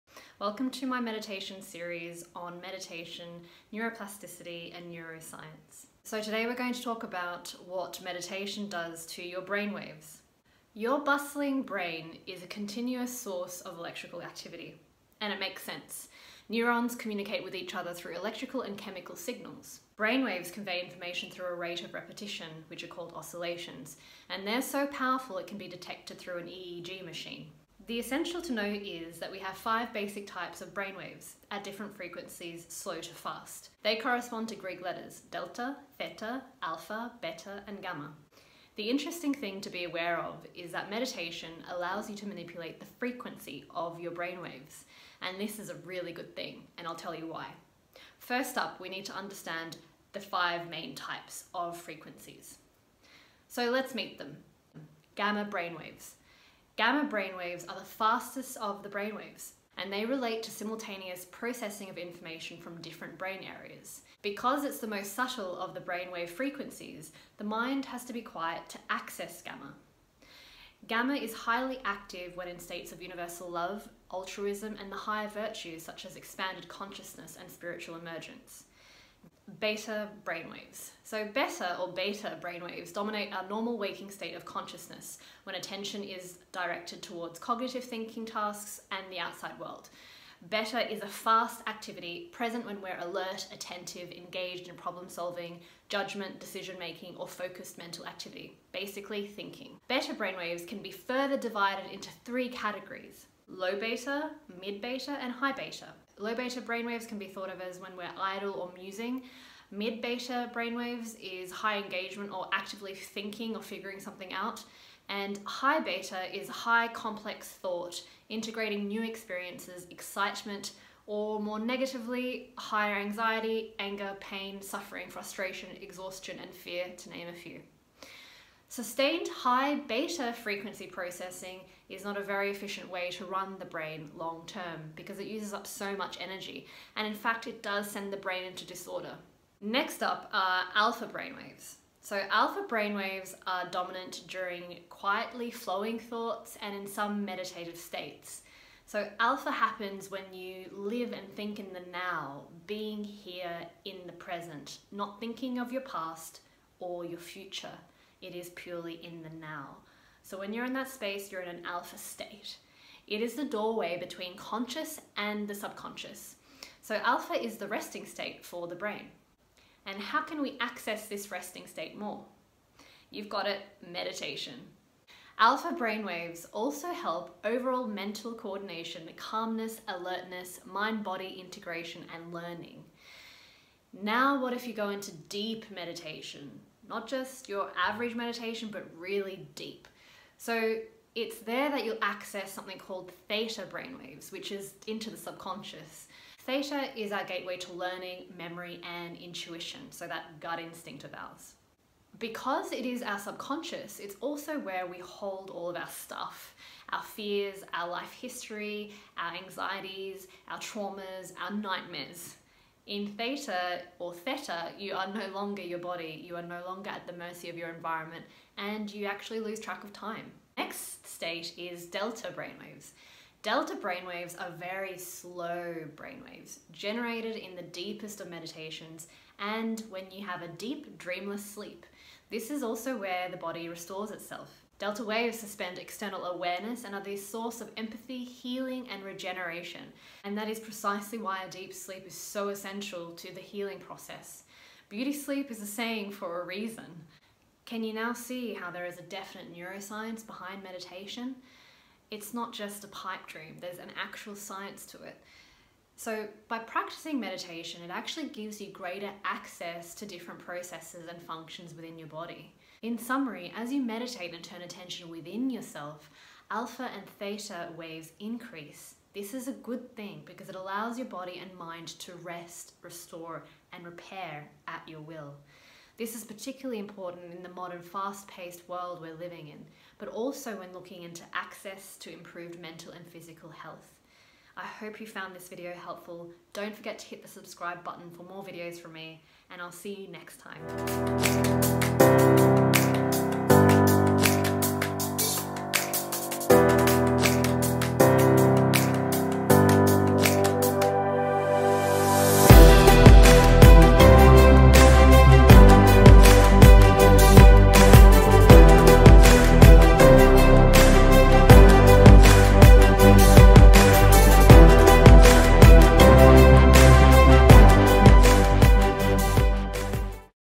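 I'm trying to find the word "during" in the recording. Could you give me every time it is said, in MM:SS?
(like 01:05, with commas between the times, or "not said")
02:24.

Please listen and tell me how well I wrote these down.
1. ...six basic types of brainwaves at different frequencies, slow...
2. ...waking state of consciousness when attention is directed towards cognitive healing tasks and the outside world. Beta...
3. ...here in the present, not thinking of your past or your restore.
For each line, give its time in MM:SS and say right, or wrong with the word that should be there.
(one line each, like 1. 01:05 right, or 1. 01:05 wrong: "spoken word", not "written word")
1. 00:29 wrong: "five", not "six"
2. 01:23 wrong: "thinking", not "healing"
3. 02:33 wrong: "future", not "restore".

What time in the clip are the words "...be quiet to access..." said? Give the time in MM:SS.
01:08.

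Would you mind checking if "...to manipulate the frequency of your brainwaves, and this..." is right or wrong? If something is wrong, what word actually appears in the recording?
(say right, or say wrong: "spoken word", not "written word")
right.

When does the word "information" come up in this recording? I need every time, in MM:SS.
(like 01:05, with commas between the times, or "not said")
00:20, 01:01.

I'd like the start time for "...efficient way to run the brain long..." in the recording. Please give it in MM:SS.
02:12.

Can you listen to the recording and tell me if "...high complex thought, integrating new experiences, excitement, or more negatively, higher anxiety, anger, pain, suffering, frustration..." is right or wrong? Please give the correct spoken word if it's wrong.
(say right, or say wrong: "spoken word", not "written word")
right.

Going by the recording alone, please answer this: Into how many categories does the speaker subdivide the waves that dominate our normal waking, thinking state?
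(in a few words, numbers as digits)
3.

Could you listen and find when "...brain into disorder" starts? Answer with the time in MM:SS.
02:18.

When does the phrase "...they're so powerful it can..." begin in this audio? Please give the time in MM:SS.
00:24.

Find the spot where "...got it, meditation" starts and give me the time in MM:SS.
02:53.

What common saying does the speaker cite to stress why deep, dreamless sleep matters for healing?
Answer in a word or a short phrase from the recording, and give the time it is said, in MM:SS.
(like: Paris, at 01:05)
Beauty sleep, at 04:04.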